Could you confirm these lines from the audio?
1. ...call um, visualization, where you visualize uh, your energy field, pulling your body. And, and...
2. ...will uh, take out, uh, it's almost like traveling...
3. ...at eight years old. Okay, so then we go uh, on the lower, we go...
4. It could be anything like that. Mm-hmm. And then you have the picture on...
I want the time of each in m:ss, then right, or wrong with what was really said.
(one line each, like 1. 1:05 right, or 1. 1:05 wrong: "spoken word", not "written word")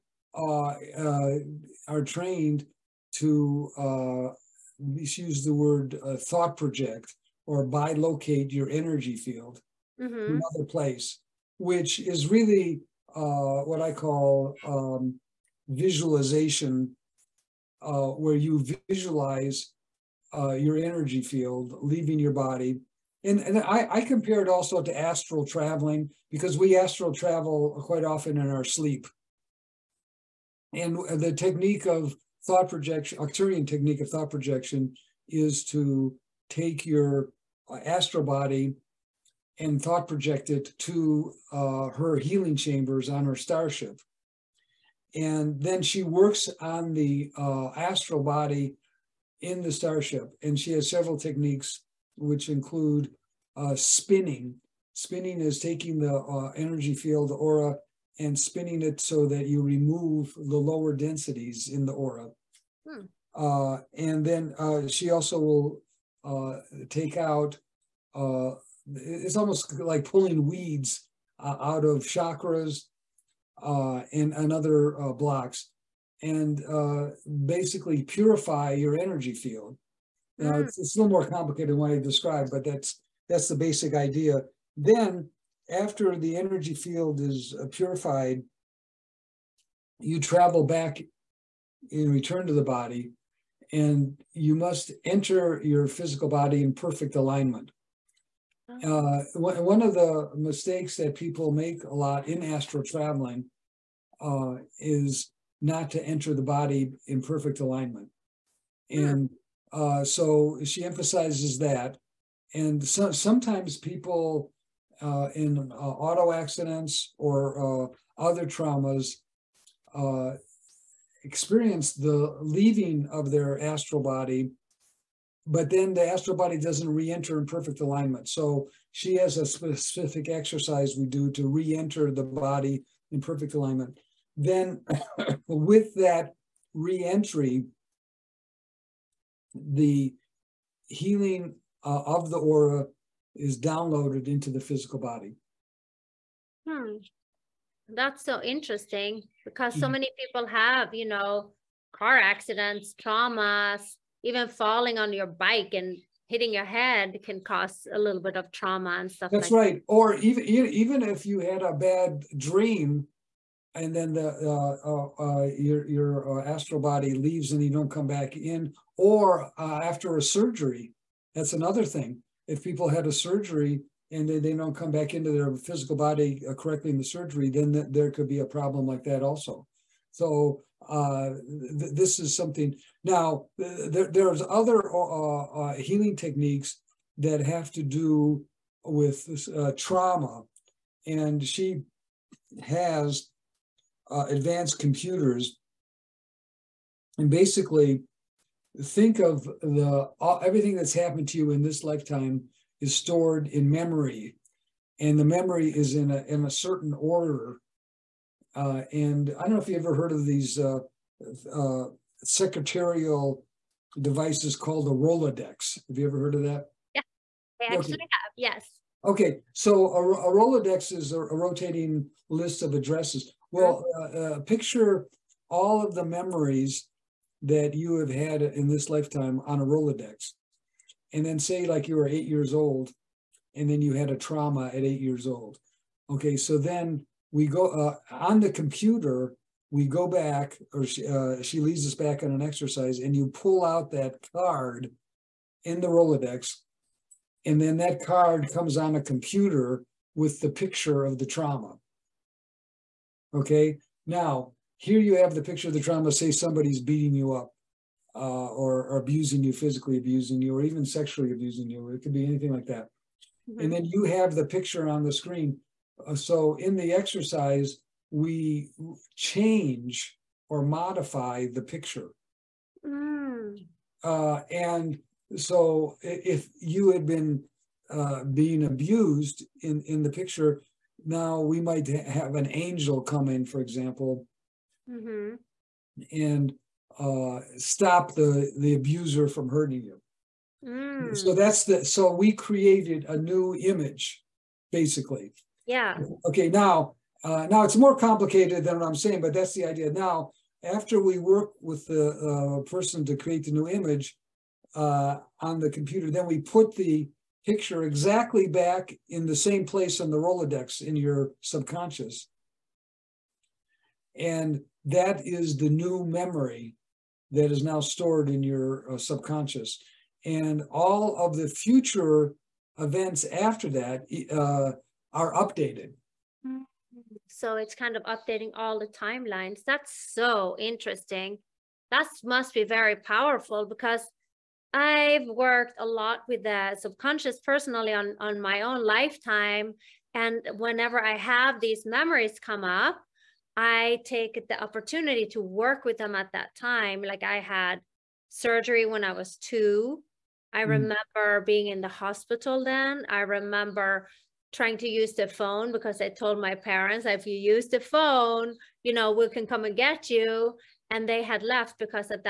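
1. 0:13 wrong: "leaving", not "pulling"
2. 1:05 wrong: "pulling", not "traveling"
3. 3:54 wrong: "computer", not "lower"
4. 4:21 right.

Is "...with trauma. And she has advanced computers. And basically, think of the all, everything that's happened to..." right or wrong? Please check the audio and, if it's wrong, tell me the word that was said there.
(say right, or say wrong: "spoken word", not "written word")
right.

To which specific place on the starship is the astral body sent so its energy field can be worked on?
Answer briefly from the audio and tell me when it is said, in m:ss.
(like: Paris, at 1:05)
Her healing chambers, at 0:41.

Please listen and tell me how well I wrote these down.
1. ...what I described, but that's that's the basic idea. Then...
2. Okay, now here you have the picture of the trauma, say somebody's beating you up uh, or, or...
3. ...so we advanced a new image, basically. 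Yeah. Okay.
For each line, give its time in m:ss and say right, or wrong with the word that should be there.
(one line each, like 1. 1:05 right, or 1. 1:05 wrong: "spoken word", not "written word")
1. 1:21 right
2. 4:13 right
3. 4:51 wrong: "created", not "advanced".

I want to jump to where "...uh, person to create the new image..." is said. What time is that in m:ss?
5:02.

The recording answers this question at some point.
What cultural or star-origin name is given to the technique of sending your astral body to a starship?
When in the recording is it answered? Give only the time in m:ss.
0:33.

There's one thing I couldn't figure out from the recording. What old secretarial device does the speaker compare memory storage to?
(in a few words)
A rotating list of addresses.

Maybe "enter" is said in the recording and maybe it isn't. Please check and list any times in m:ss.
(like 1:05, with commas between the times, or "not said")
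1:35, 1:46, 2:06, 2:11.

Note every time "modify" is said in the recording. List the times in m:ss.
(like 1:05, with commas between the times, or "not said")
4:30.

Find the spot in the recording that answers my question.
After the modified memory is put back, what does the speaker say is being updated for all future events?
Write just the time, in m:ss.
5:28.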